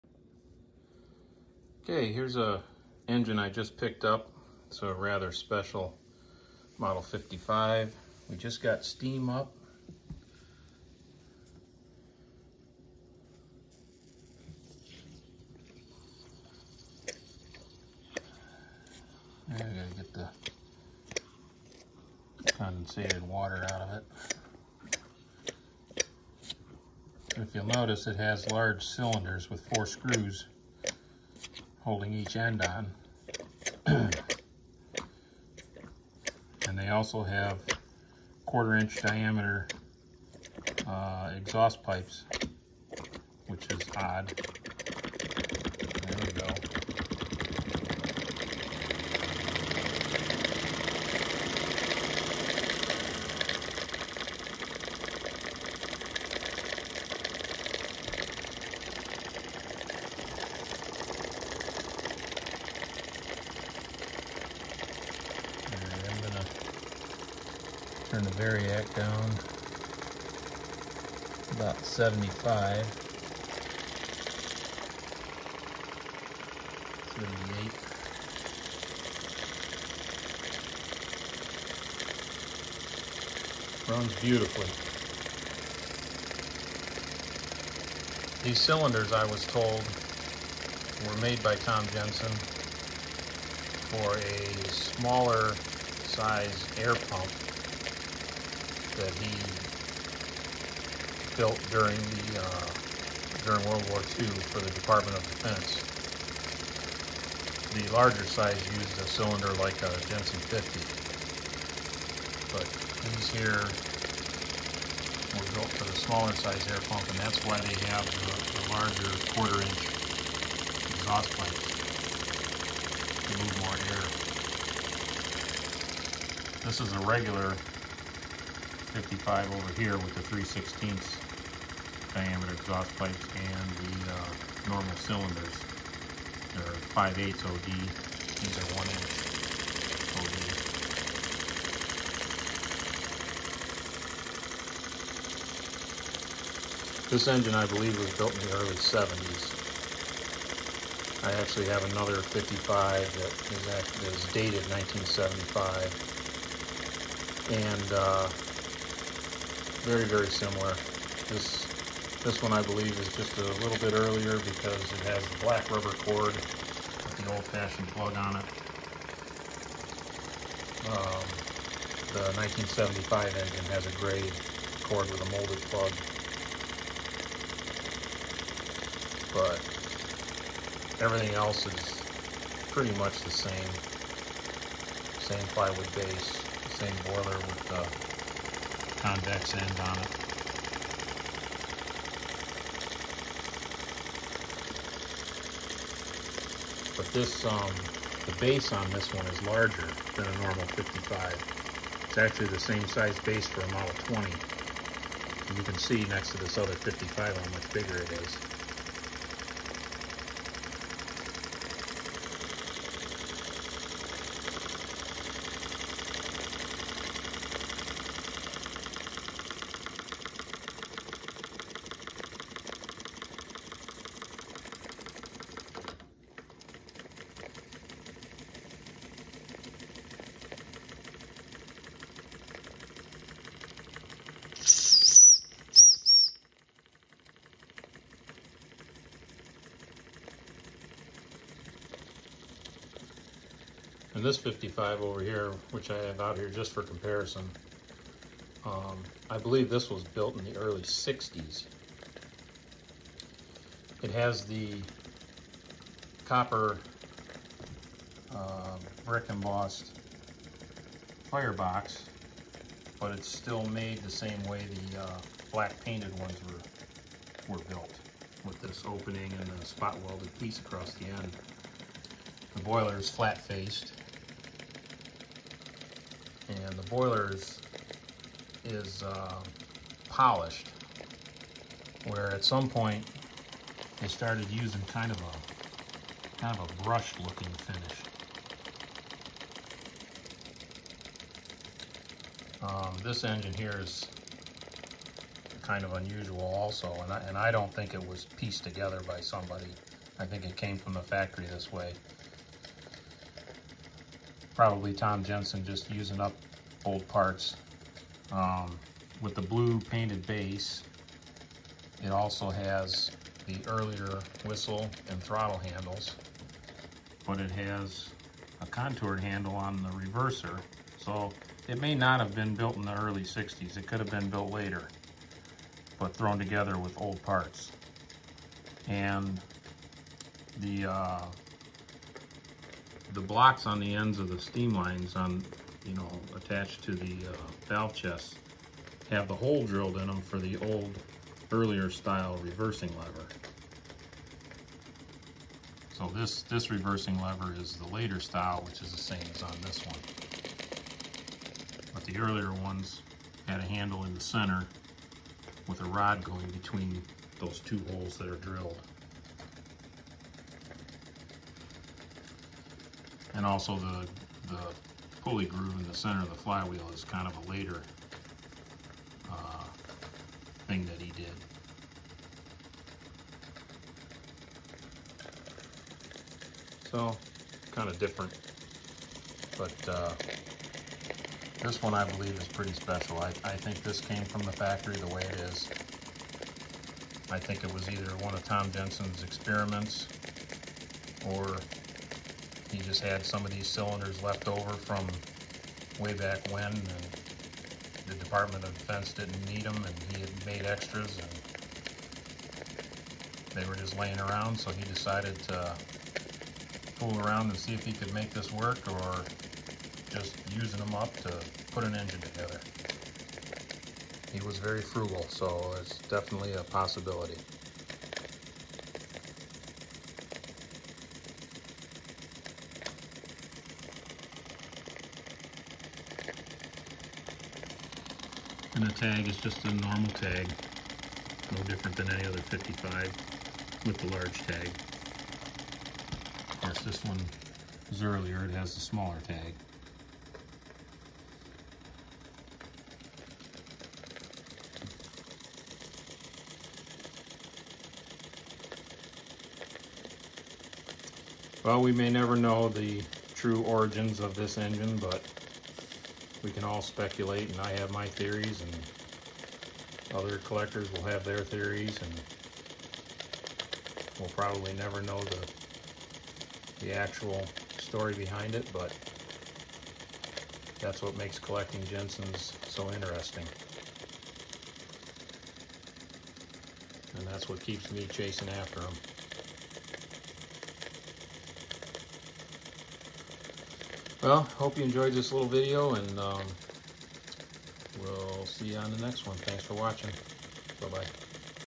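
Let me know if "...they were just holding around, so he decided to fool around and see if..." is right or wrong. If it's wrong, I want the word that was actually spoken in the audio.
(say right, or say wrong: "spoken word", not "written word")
wrong: "laying", not "holding".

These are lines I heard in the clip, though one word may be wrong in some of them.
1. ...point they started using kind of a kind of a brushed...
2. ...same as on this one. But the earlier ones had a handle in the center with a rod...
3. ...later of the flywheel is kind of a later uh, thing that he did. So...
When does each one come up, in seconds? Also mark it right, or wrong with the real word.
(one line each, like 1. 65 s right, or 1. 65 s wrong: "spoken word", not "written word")
1. 282 s right
2. 349 s right
3. 365 s wrong: "center", not "later".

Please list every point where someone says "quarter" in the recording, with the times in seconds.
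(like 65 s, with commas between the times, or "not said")
38 s, 119 s.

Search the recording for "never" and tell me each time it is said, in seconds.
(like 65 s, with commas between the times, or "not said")
452 s, 464 s.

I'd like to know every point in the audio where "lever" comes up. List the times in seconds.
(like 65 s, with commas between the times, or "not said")
342 s, 347 s.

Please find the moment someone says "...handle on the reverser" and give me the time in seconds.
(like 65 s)
319 s.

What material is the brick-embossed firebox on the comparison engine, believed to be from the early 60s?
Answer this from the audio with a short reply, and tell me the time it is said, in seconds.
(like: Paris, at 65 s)
copper, at 256 s.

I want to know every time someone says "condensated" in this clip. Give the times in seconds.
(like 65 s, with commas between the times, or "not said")
22 s.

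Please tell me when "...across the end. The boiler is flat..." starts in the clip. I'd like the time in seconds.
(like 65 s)
270 s.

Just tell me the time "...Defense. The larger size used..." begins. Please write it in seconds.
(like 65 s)
105 s.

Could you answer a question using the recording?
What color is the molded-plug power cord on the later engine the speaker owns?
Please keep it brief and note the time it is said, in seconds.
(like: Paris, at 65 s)
gray, at 173 s.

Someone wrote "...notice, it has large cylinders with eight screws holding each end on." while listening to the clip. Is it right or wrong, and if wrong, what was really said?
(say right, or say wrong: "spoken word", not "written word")
wrong: "four", not "eight".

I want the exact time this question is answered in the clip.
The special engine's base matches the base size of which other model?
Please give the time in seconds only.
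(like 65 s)
203 s.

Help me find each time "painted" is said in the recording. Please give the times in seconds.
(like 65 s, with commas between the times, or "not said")
265 s, 309 s.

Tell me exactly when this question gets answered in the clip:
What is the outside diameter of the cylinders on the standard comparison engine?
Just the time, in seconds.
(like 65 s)
136 s.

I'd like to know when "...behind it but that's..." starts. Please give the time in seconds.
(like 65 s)
468 s.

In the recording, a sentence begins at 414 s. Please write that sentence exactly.
He was very frugal, so it's definitely a possibility.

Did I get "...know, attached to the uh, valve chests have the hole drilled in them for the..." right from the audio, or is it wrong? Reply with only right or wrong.
right.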